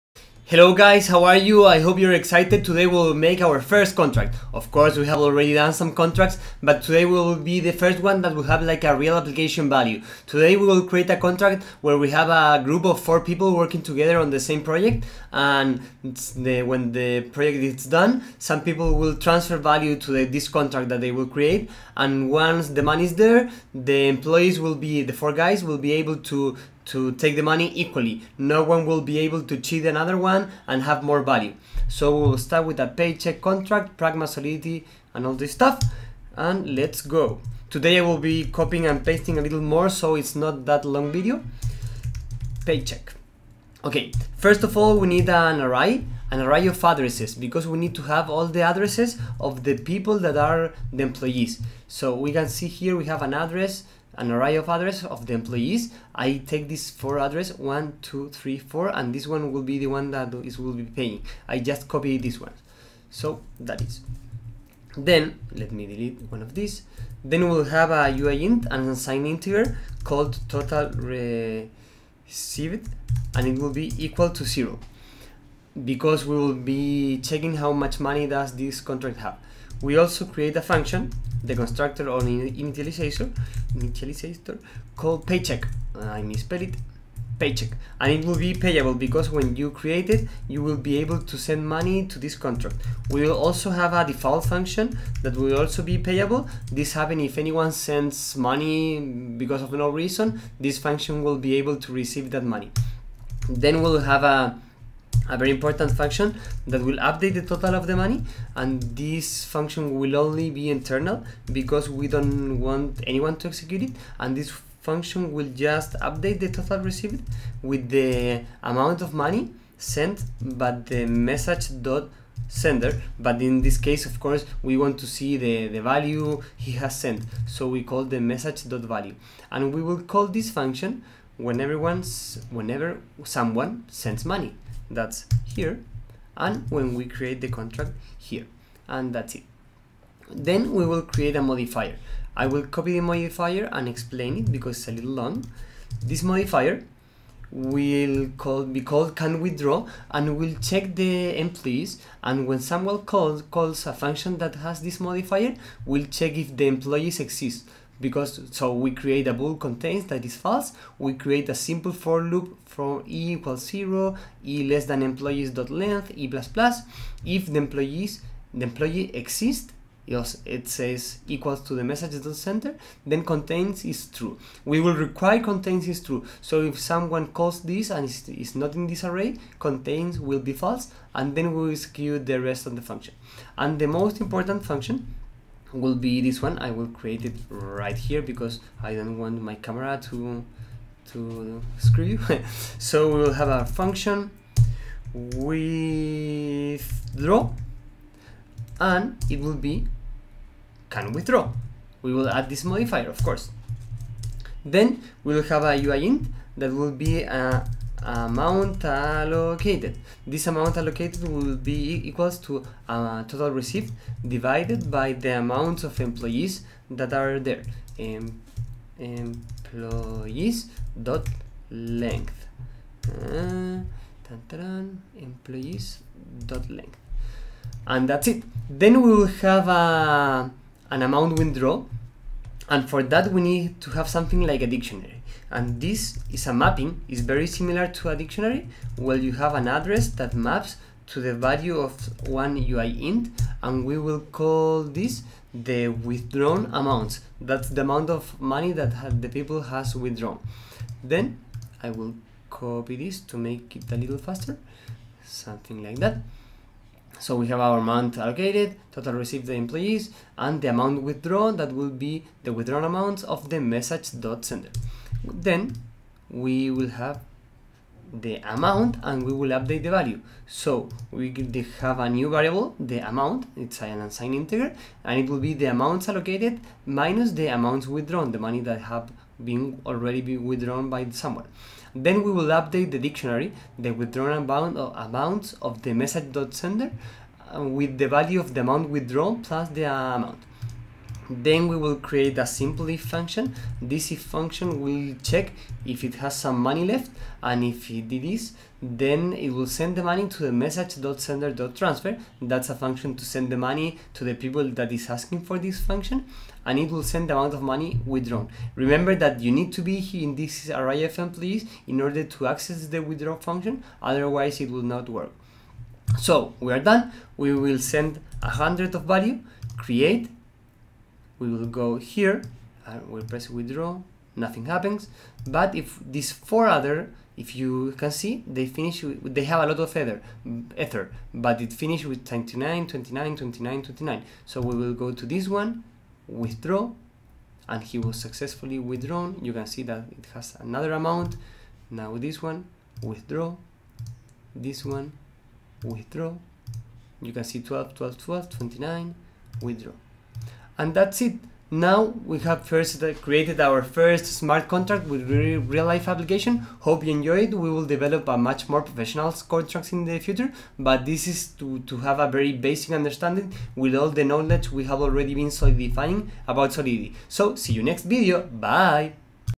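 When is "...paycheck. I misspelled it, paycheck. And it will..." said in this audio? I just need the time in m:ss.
1:25.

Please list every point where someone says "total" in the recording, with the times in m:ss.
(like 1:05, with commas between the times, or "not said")
1:10, 1:47, 1:56, 3:33, 4:18.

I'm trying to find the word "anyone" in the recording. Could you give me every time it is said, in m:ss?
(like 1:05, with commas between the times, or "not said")
1:37, 1:53.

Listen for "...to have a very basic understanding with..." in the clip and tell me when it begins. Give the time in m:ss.
6:01.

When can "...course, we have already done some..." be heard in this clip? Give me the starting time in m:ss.
0:04.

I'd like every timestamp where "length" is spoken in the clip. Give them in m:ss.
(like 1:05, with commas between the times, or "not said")
2:45, 3:41, 3:46.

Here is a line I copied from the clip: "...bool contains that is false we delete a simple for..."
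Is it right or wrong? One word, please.
wrong.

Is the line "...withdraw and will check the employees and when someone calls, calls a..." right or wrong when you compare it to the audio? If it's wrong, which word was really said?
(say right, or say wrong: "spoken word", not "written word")
right.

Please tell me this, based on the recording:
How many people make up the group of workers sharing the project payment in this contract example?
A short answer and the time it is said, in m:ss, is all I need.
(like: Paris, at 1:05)
4, at 0:12.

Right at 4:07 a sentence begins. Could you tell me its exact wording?
That's the amount of money that the people has withdrawn.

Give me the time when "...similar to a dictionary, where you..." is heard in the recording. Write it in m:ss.
3:57.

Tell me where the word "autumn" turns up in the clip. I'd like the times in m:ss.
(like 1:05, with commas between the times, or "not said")
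not said.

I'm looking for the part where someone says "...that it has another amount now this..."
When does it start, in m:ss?
5:39.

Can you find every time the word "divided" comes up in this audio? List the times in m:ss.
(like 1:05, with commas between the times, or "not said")
3:34.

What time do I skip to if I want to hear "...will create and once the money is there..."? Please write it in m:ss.
0:21.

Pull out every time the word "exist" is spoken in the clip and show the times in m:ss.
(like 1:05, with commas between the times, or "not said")
2:37, 2:49.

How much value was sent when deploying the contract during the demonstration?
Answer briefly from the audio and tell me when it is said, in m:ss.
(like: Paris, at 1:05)
100, at 5:18.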